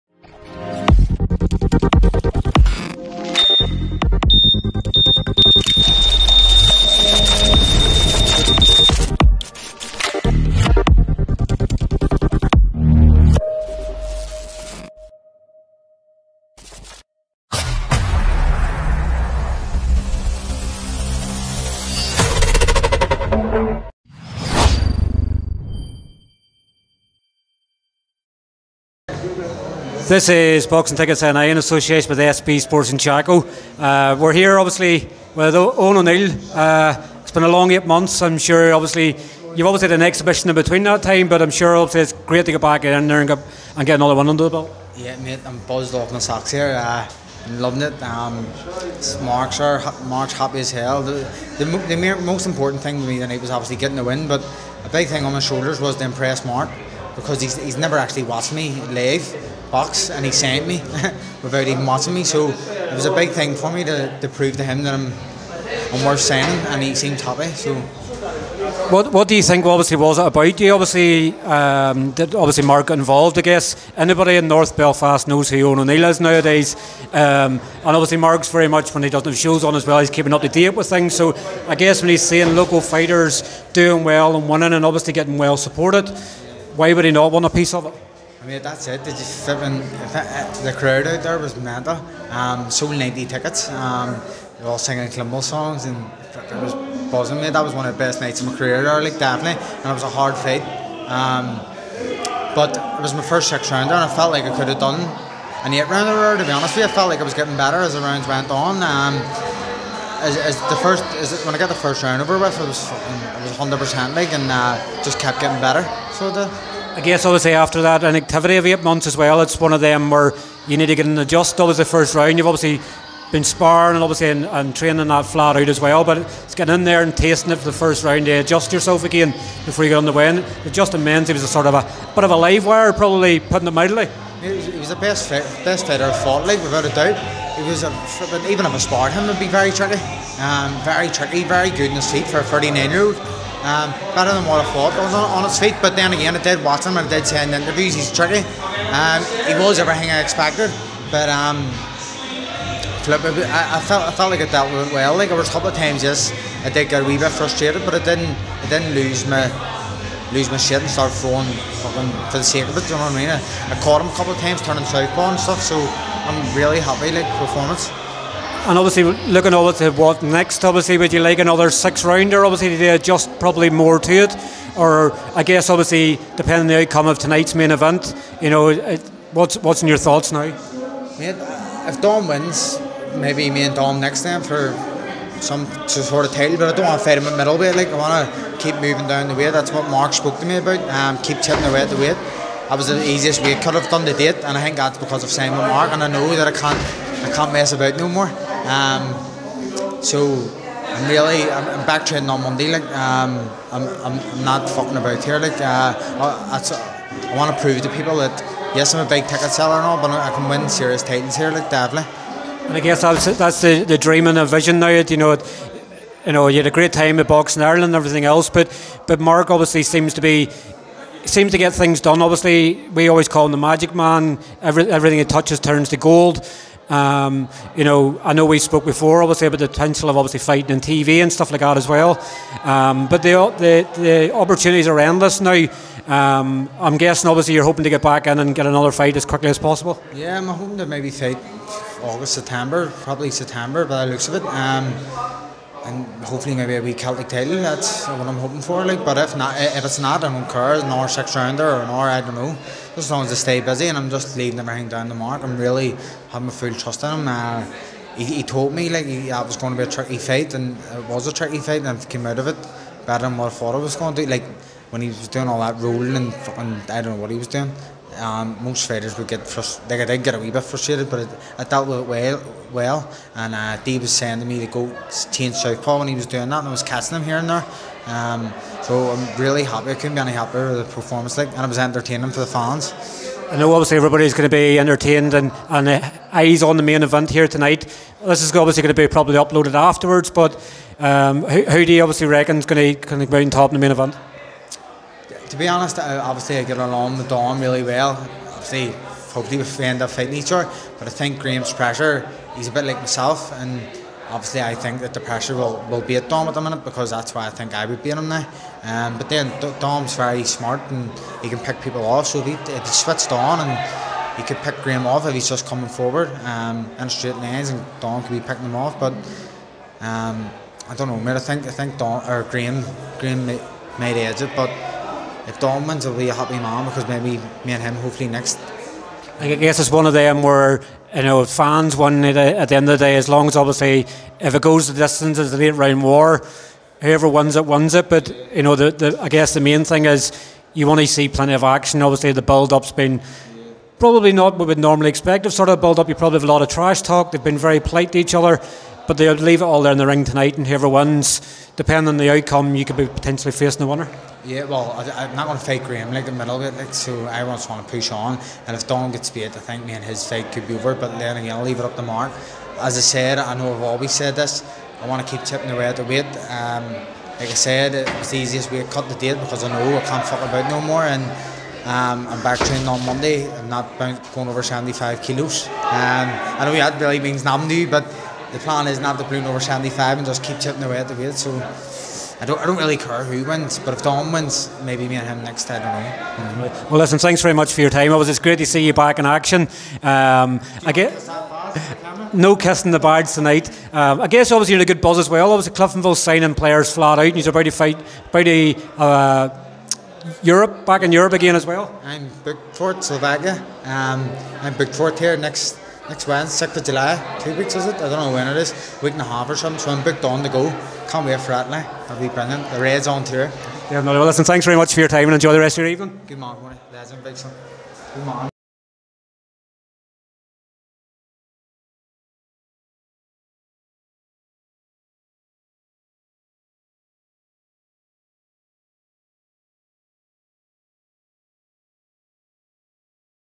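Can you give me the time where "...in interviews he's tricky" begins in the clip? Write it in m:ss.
2:27.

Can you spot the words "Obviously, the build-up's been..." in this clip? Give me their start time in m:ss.
5:42.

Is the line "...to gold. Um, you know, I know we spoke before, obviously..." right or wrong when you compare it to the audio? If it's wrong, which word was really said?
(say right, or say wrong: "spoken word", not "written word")
right.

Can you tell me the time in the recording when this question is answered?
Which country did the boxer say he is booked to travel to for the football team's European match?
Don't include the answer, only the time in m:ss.
6:43.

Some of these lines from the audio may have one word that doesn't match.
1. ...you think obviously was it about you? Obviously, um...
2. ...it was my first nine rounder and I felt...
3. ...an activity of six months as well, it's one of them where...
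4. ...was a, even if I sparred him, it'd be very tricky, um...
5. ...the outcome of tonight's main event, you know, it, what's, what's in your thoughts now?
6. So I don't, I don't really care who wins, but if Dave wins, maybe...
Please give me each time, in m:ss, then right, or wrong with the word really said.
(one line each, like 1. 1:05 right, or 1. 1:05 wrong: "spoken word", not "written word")
1. 1:09 right
2. 1:42 wrong: "six", not "nine"
3. 1:58 wrong: "eight", not "six"
4. 2:17 right
5. 2:56 right
6. 6:21 wrong: "Dom", not "Dave".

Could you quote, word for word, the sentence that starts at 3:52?
Um, but the, the, the opportunities are endless now.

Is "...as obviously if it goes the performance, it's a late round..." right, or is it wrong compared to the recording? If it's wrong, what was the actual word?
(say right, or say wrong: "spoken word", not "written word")
wrong: "distance", not "performance".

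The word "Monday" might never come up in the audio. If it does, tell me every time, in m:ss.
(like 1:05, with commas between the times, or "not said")
3:22, 6:13.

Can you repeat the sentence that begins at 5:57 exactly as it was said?
I just want to push on, and if Donald gets beat, I think me and his fight could be over.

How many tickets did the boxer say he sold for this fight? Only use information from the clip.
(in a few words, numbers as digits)
90.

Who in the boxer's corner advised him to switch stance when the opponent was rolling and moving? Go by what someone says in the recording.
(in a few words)
Dave.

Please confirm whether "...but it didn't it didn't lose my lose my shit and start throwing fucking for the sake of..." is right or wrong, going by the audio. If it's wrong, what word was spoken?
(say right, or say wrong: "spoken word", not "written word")
right.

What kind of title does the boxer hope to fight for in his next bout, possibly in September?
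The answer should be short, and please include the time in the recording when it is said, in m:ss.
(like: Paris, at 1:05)
Celtic title, at 4:06.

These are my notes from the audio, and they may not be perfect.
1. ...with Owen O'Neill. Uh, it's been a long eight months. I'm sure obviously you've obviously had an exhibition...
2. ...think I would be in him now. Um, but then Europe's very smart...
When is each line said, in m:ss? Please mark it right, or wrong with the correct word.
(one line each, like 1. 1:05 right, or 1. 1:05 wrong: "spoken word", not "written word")
1. 0:35 right
2. 5:07 wrong: "Dom", not "Europe".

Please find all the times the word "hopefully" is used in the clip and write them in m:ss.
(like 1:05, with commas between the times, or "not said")
4:06, 4:59, 5:27.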